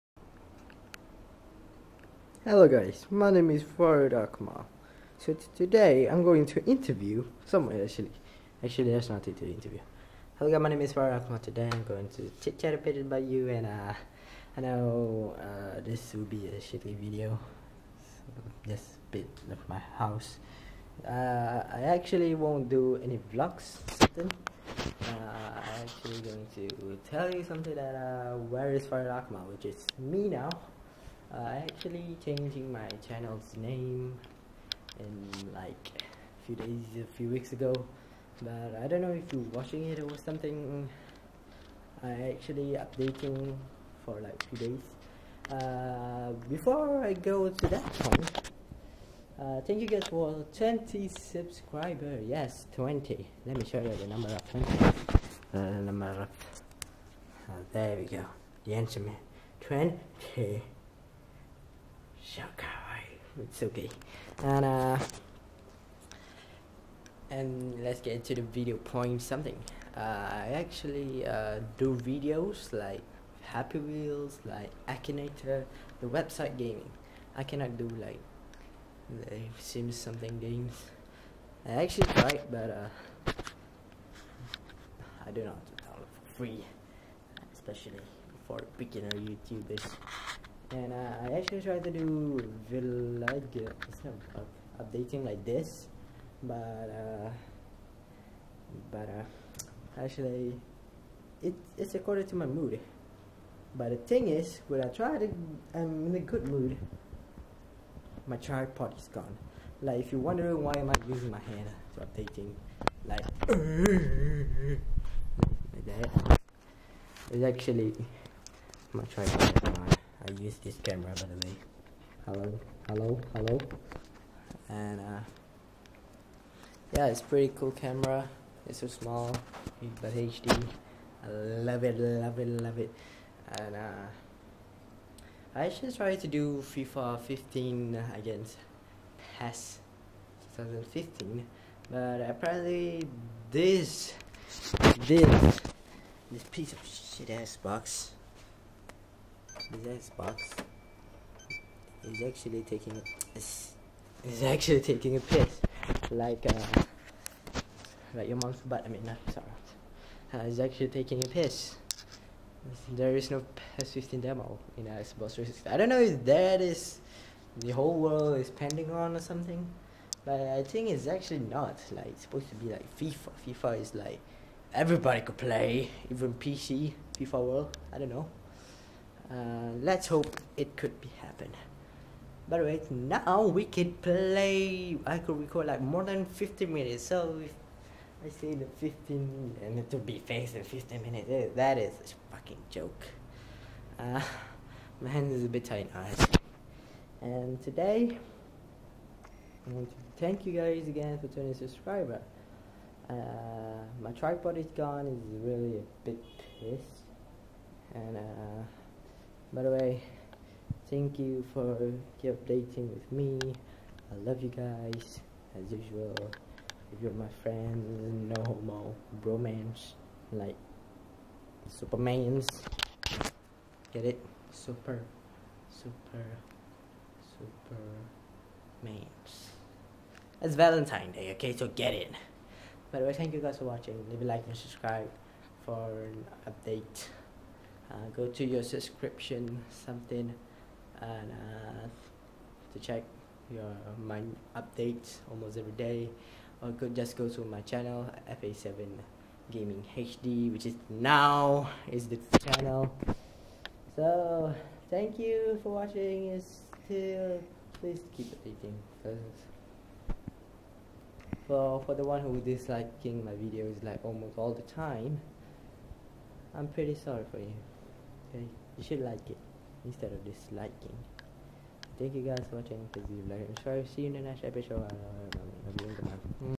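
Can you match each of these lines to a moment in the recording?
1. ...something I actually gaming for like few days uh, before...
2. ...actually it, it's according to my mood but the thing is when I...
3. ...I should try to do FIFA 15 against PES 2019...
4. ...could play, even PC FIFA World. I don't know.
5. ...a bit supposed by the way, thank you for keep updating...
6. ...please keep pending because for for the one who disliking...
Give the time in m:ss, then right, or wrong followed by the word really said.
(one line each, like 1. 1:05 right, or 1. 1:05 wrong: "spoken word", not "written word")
1. 0:40 wrong: "updating", not "gaming"
2. 1:40 right
3. 2:15 wrong: "2015", not "2019"
4. 2:55 right
5. 3:25 wrong: "pissed", not "supposed"
6. 4:17 wrong: "updating", not "pending".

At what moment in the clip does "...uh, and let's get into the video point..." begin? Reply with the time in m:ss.
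1:04.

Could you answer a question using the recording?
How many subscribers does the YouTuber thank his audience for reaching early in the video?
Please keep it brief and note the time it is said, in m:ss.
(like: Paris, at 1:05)
20, at 0:50.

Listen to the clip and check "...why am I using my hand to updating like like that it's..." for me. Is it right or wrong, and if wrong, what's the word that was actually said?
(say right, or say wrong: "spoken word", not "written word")
right.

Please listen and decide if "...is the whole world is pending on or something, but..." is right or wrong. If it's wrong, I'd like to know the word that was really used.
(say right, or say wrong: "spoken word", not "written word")
right.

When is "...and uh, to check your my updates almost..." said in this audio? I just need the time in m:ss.
4:01.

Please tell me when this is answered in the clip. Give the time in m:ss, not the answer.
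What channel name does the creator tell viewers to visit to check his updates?
4:08.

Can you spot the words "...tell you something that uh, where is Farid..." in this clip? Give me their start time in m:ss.
0:27.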